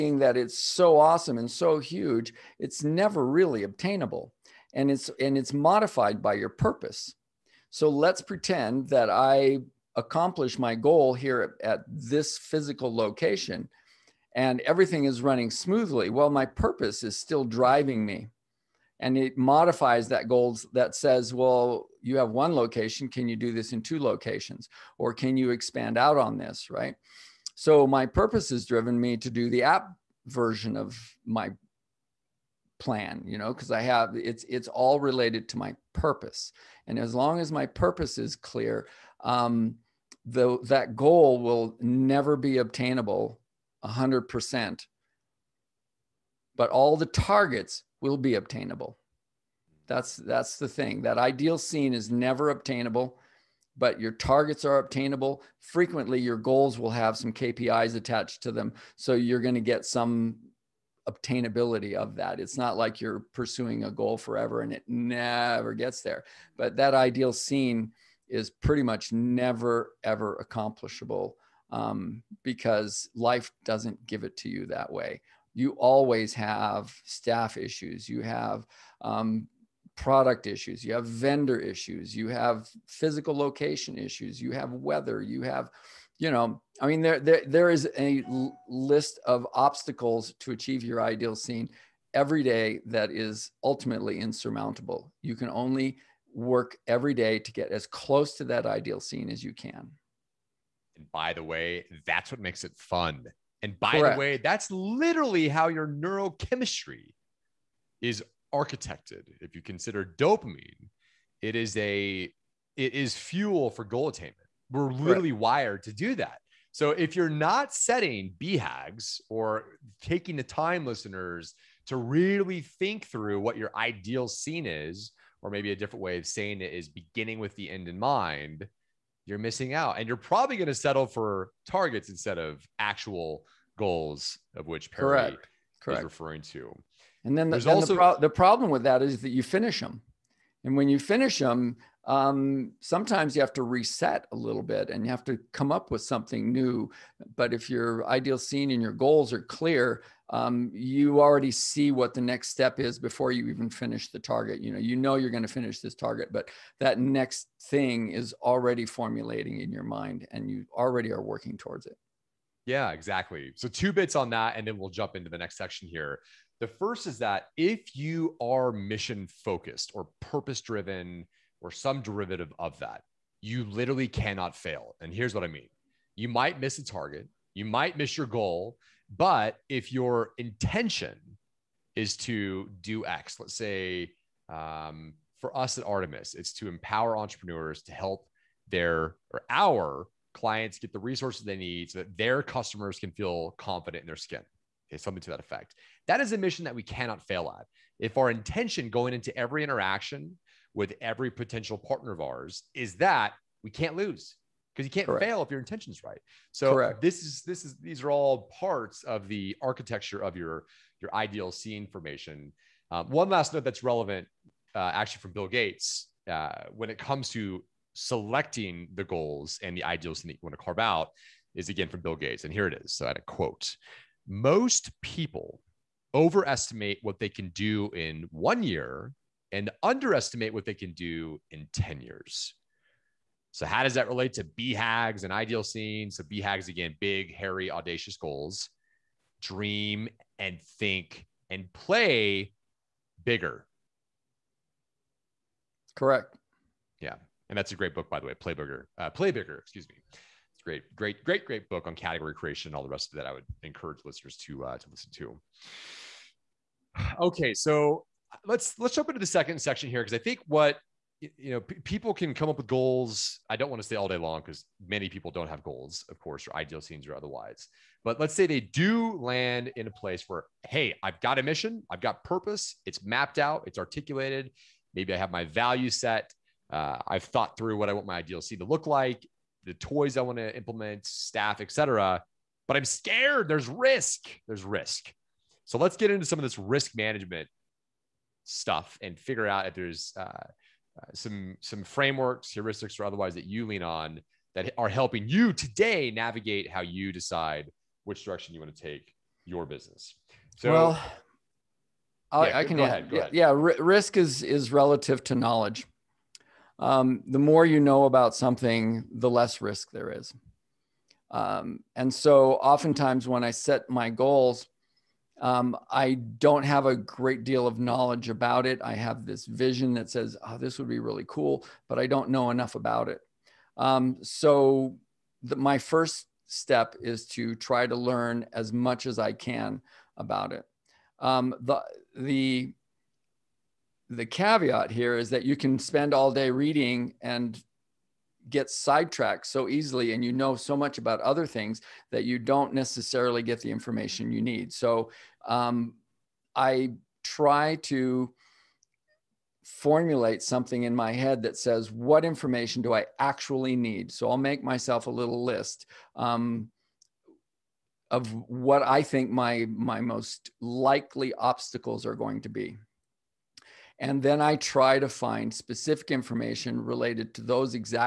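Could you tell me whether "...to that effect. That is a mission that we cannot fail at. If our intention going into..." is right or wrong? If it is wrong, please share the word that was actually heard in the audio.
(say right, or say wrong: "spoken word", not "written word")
right.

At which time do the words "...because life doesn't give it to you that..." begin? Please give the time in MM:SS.
01:12.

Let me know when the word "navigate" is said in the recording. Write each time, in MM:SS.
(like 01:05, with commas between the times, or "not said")
04:56.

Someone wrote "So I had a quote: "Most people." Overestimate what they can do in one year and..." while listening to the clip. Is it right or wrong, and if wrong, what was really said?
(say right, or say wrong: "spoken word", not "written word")
right.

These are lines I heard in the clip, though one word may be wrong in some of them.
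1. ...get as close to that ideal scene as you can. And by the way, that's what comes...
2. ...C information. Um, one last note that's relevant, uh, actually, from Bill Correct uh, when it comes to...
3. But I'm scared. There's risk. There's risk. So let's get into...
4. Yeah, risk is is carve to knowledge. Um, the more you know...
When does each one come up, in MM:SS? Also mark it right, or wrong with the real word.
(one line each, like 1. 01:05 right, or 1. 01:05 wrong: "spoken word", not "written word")
1. 01:37 wrong: "makes", not "comes"
2. 03:31 wrong: "Gates", not "Correct"
3. 04:42 right
4. 05:03 wrong: "relative", not "carve".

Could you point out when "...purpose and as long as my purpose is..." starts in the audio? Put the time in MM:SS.
00:35.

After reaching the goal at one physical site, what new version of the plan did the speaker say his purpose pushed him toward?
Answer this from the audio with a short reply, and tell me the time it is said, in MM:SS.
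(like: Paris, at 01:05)
app, at 00:29.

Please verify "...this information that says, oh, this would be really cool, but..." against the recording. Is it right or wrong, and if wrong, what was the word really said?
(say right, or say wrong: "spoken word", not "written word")
wrong: "vision", not "information".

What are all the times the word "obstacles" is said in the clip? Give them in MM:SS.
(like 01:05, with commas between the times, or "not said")
01:29, 06:01.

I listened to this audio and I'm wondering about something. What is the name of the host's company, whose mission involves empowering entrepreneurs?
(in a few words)
Artemis.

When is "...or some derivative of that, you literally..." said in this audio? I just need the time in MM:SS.
02:51.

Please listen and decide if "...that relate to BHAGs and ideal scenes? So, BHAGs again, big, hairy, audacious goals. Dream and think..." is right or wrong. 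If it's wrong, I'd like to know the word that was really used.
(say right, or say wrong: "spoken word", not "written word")
right.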